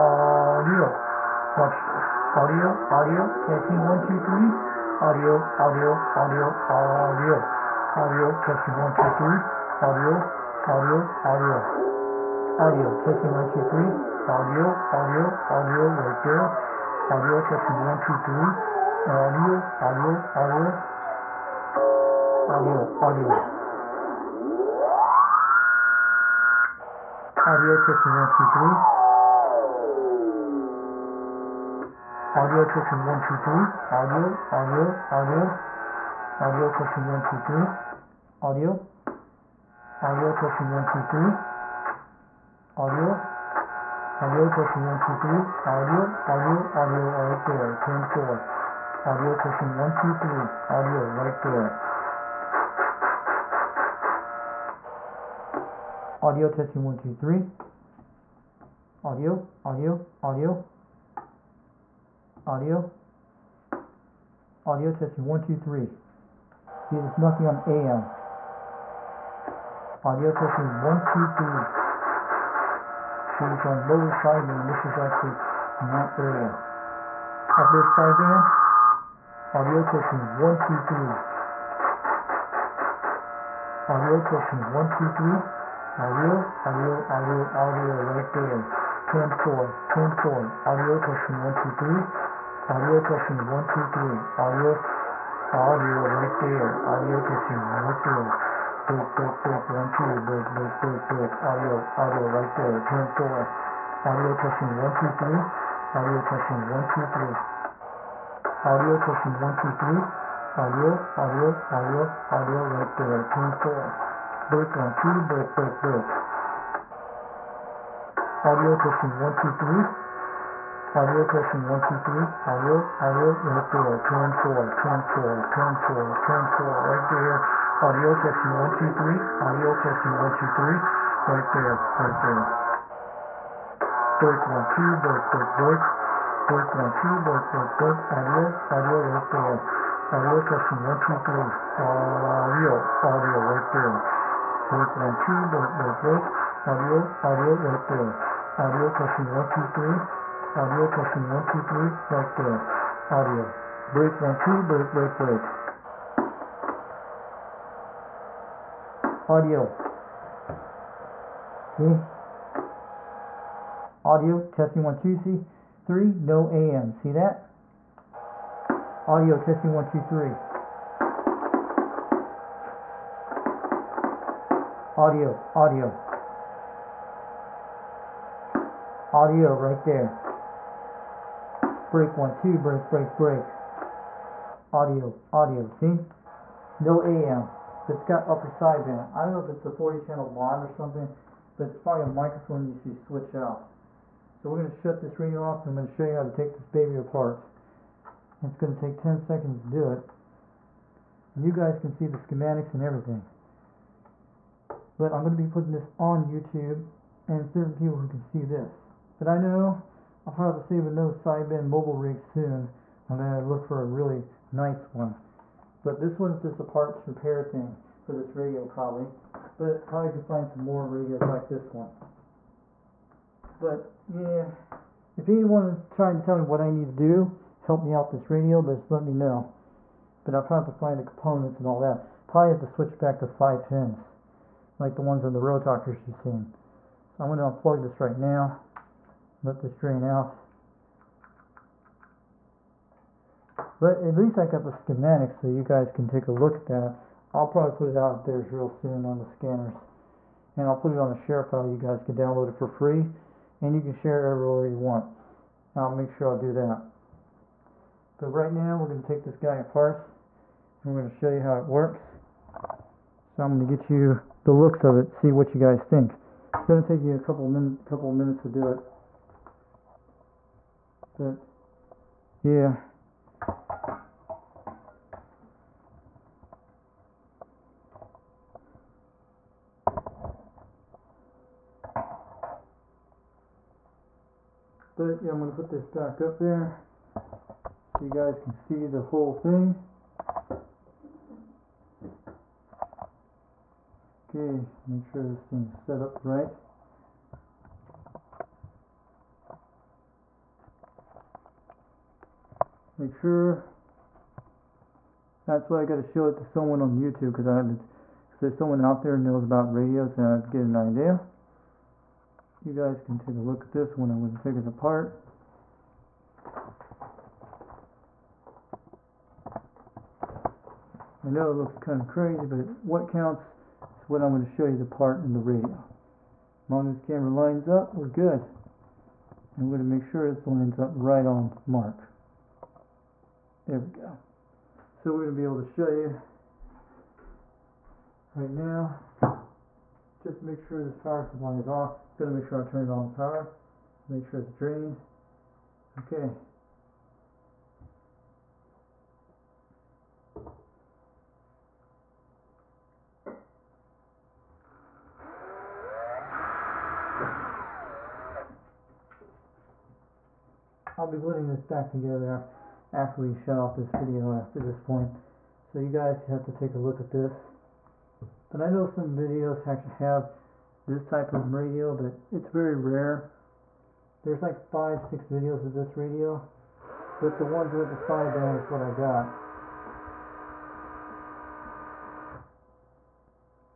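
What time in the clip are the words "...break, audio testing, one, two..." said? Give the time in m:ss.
1:55.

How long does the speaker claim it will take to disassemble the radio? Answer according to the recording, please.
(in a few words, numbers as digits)
10 seconds.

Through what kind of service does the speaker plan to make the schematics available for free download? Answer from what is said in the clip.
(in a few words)
share file.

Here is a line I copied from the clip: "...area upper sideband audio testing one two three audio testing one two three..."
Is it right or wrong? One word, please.
right.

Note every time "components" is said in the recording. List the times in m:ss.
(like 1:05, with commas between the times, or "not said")
3:51.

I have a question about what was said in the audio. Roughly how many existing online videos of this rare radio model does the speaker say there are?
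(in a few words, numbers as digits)
5 or 6.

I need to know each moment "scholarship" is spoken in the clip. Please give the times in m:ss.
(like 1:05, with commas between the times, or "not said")
not said.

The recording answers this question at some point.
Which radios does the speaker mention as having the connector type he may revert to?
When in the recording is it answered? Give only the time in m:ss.
3:55.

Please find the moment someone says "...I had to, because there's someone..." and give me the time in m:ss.
5:07.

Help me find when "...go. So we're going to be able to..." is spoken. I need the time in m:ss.
5:34.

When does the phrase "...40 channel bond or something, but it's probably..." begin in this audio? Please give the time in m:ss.
3:09.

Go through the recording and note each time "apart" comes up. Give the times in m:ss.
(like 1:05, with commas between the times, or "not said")
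3:16, 4:19, 5:14.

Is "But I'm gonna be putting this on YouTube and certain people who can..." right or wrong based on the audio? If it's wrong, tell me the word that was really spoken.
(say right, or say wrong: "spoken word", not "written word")
right.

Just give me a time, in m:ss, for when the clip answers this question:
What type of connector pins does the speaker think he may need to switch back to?
3:53.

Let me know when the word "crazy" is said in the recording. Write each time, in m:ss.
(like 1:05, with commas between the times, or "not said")
5:22.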